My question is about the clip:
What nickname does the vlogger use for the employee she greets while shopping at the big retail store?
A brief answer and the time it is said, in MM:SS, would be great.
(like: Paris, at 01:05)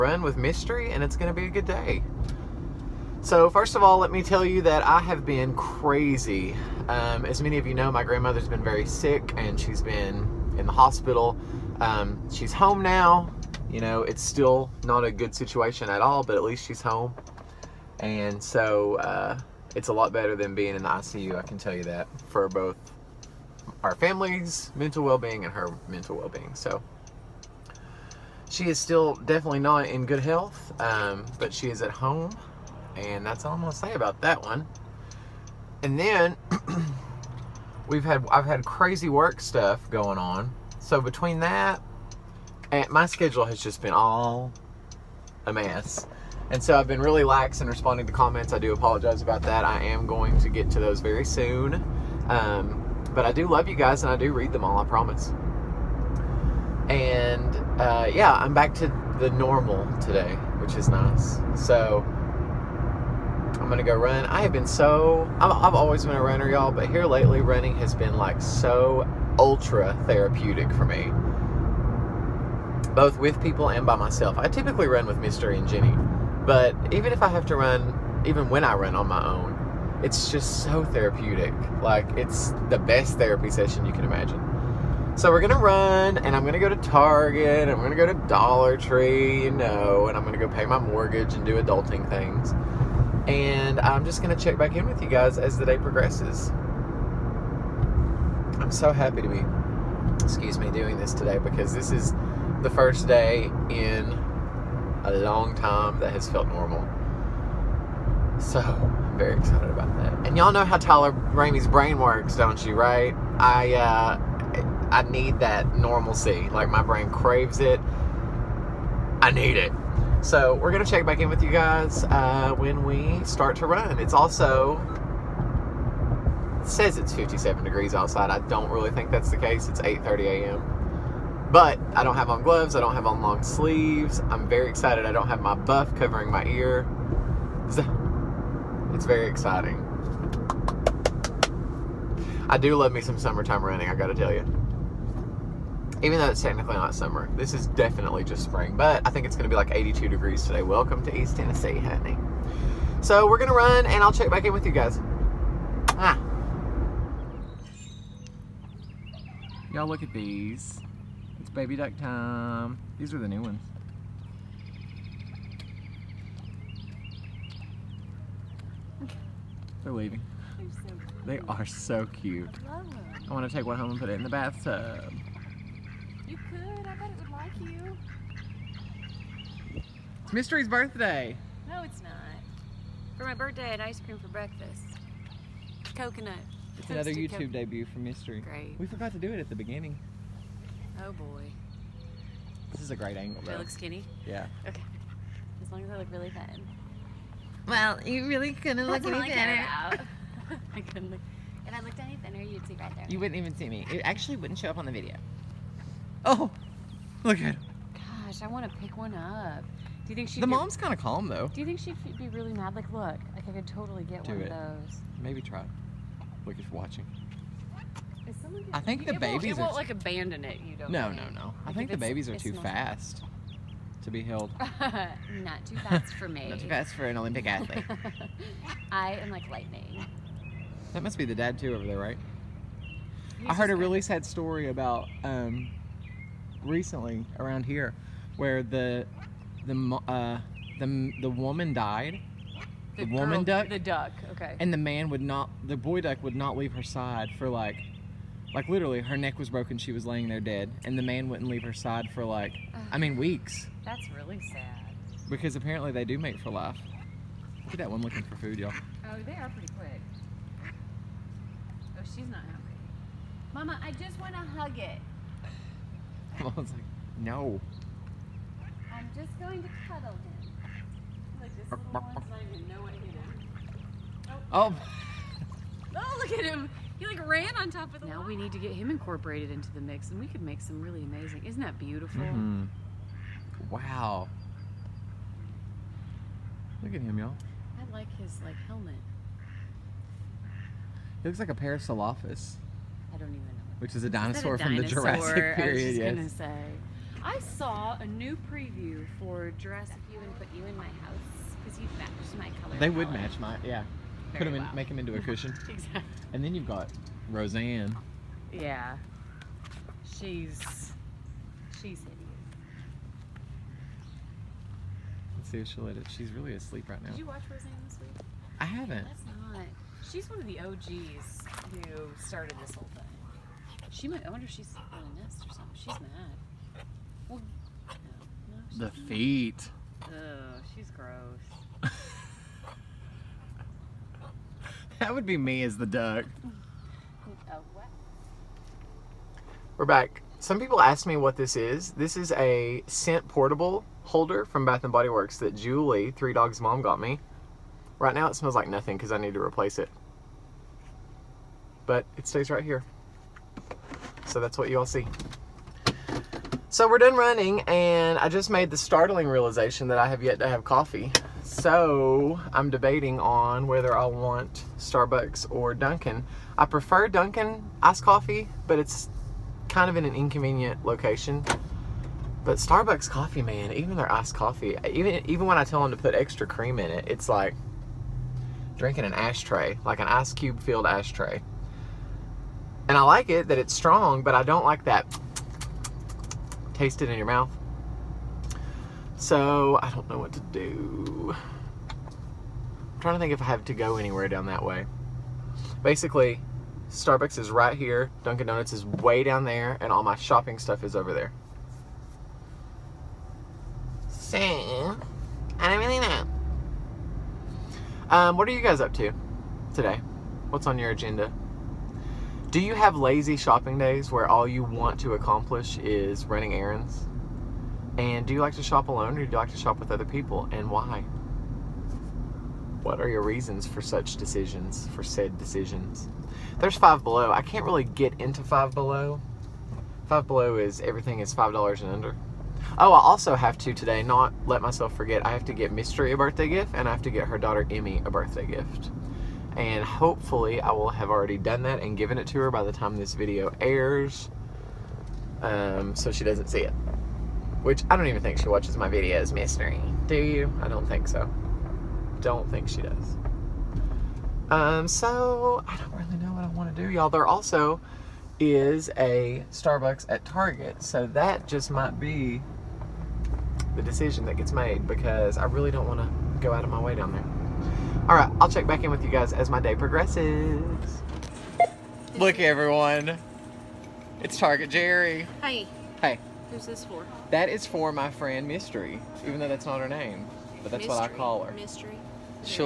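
Target Jerry, at 07:54.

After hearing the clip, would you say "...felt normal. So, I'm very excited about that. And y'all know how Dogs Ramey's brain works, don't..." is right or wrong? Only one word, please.
wrong.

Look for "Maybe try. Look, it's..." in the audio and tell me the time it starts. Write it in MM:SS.
03:35.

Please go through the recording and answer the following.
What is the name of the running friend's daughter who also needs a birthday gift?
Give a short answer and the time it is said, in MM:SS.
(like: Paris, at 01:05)
Emmy, at 07:17.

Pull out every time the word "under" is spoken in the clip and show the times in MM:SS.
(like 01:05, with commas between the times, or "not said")
07:11.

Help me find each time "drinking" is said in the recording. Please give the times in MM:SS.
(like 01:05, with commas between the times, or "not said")
06:18.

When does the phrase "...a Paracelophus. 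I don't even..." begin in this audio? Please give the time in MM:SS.
04:51.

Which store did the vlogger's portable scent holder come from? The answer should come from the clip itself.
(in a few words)
Bath and Body Works.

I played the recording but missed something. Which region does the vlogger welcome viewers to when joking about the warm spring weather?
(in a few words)
East Tennessee.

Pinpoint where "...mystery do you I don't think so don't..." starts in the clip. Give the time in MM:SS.
07:29.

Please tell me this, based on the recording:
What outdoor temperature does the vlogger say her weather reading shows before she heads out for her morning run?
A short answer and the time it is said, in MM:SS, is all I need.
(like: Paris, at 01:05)
57 degrees, at 02:07.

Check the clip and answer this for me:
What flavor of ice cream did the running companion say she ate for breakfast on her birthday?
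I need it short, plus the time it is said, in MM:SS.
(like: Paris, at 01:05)
Coconut, at 03:05.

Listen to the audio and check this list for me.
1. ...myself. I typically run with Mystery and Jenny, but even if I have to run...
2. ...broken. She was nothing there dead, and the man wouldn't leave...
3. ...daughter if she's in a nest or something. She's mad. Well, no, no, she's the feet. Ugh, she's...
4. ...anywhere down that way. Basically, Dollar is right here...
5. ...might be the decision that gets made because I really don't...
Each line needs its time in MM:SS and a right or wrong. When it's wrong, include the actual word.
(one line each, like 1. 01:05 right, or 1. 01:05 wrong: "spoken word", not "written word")
1. 01:13 right
2. 04:09 wrong: "laying", not "nothing"
3. 05:24 wrong: "wonder", not "daughter"
4. 06:33 wrong: "Starbucks", not "Dollar"
5. 07:41 right.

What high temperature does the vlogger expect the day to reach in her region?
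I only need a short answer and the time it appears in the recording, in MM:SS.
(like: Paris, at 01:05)
82 degrees, at 02:29.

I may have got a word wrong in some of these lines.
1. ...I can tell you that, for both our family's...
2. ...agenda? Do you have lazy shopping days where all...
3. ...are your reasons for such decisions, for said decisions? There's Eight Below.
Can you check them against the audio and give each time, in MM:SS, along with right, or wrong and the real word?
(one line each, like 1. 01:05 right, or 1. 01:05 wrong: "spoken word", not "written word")
1. 00:21 right
2. 06:50 right
3. 07:02 wrong: "Five", not "Eight".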